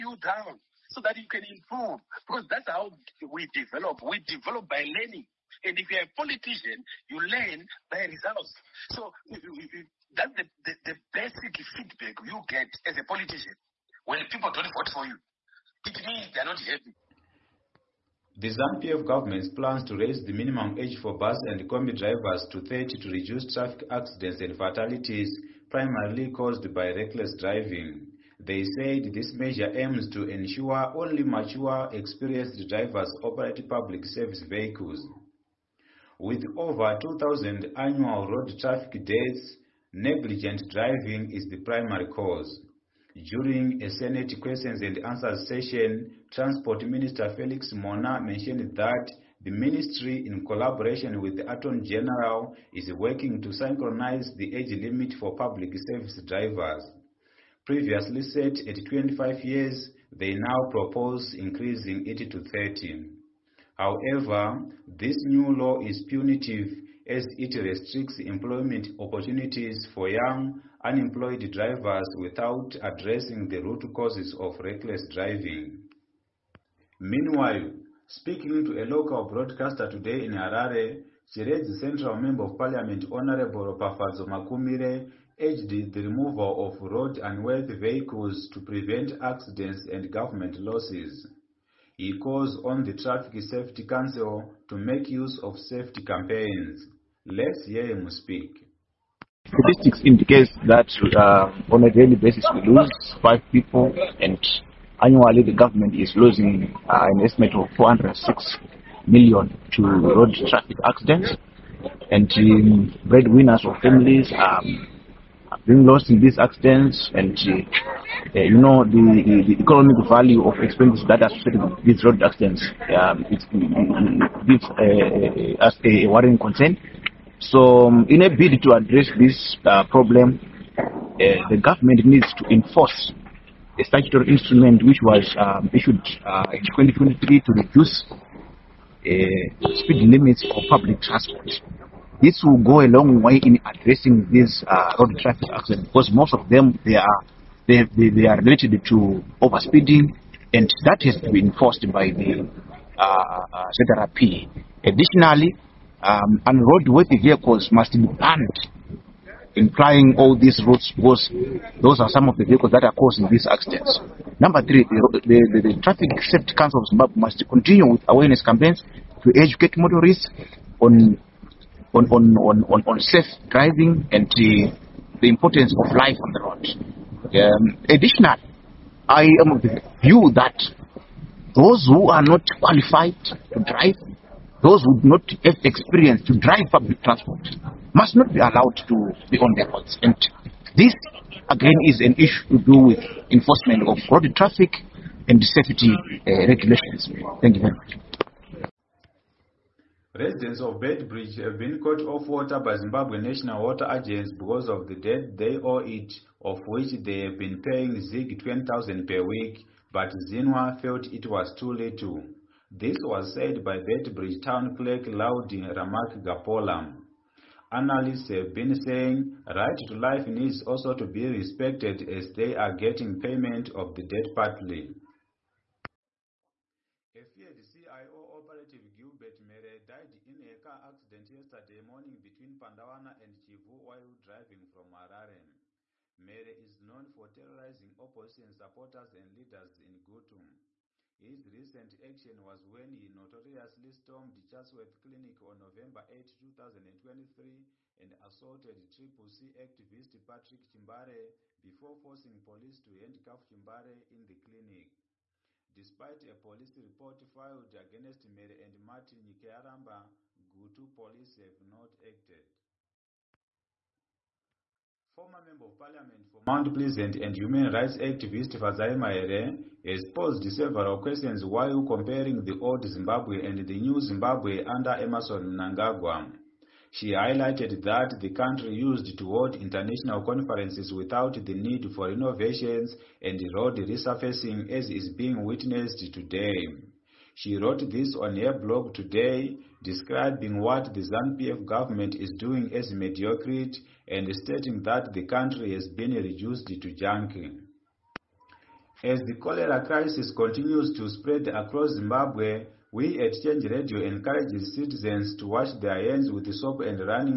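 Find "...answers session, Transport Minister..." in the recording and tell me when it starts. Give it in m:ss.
0:44.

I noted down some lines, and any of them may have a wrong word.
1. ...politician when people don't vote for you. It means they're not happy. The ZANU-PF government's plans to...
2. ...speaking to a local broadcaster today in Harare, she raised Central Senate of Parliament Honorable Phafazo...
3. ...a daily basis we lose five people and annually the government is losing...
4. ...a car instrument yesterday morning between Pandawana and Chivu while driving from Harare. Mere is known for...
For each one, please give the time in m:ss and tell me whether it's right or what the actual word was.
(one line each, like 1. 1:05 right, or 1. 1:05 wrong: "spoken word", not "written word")
1. 0:13 right
2. 1:18 wrong: "Member", not "Senate"
3. 1:41 right
4. 3:50 wrong: "accident", not "instrument".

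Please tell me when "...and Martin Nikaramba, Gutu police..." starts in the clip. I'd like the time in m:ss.
4:18.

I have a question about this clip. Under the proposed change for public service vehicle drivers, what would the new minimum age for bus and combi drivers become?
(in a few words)
30.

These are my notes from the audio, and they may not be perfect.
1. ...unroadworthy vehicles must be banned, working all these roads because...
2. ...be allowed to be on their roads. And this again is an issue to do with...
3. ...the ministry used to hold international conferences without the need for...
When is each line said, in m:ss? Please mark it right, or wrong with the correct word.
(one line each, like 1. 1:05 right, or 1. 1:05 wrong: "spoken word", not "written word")
1. 2:36 wrong: "implying", not "working"
2. 3:08 right
3. 4:38 wrong: "country", not "ministry".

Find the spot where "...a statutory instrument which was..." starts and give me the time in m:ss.
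2:13.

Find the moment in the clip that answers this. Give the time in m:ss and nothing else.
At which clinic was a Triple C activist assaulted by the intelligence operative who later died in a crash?
4:04.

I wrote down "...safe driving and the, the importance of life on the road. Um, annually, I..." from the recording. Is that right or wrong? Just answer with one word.
wrong.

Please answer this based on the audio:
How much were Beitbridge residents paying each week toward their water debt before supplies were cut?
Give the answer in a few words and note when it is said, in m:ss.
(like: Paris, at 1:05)
ZIG 20,000, at 3:28.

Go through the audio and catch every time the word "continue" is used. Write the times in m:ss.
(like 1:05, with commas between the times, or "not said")
2:47, 5:00.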